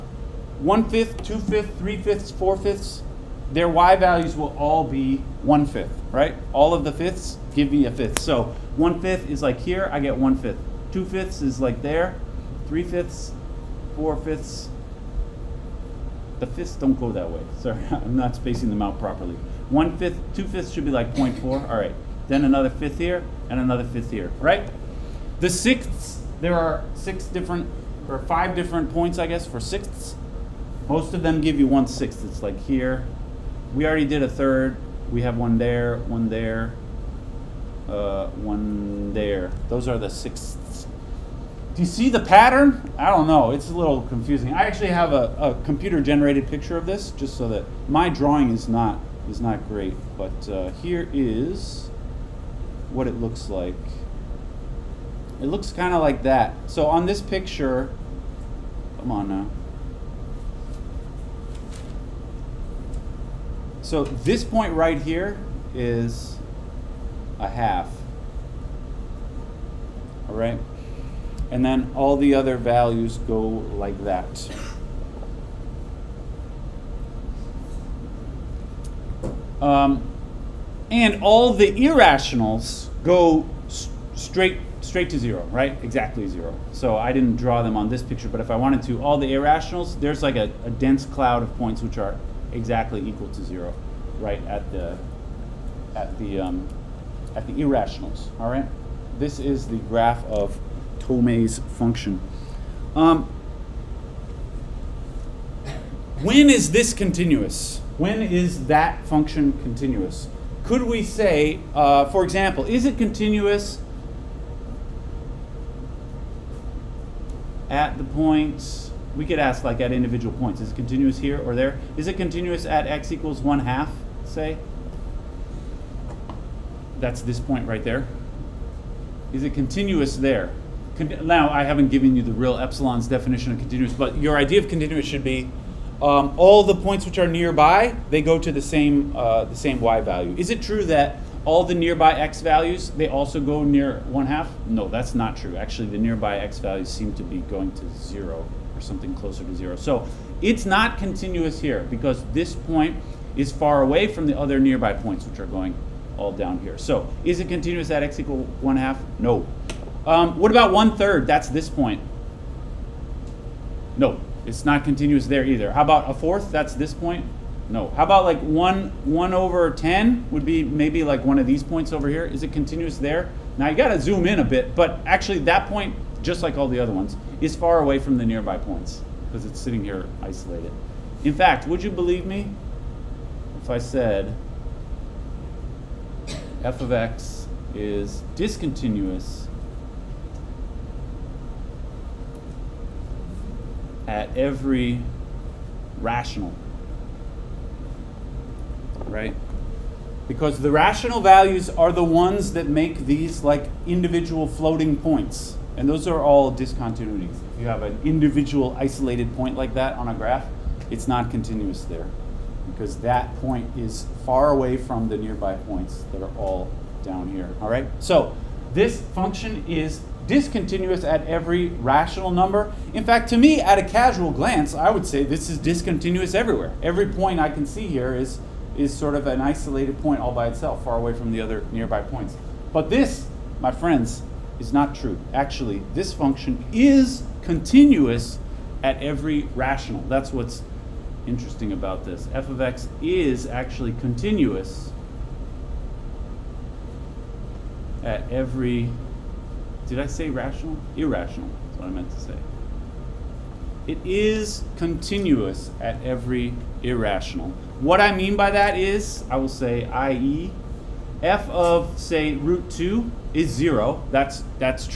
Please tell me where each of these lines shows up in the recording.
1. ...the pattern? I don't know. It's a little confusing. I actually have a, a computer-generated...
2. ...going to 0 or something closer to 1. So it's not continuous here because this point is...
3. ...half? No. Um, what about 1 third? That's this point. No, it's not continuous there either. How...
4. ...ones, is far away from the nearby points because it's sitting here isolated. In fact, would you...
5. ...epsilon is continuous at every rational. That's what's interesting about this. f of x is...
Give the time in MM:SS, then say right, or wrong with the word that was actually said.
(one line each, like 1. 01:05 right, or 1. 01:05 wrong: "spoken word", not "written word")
1. 00:42 right
2. 02:27 wrong: "0", not "1"
3. 02:38 right
4. 02:56 right
5. 03:56 wrong: "function", not "epsilon".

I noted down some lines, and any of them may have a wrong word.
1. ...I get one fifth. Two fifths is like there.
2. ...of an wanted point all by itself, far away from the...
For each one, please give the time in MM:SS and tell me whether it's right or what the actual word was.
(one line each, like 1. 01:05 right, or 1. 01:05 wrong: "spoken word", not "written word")
1. 00:09 right
2. 03:49 wrong: "isolated", not "wanted".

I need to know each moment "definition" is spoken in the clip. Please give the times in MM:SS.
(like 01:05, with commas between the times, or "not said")
02:13.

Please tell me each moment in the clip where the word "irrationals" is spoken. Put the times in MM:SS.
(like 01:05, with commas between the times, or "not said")
01:21, 01:29, 01:37, 04:10, 04:16.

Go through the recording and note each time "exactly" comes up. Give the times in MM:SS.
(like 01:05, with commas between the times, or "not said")
01:25, 01:32.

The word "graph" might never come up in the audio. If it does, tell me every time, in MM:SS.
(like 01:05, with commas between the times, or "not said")
01:39, 03:30.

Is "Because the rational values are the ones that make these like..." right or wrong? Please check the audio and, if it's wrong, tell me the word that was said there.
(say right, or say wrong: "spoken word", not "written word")
right.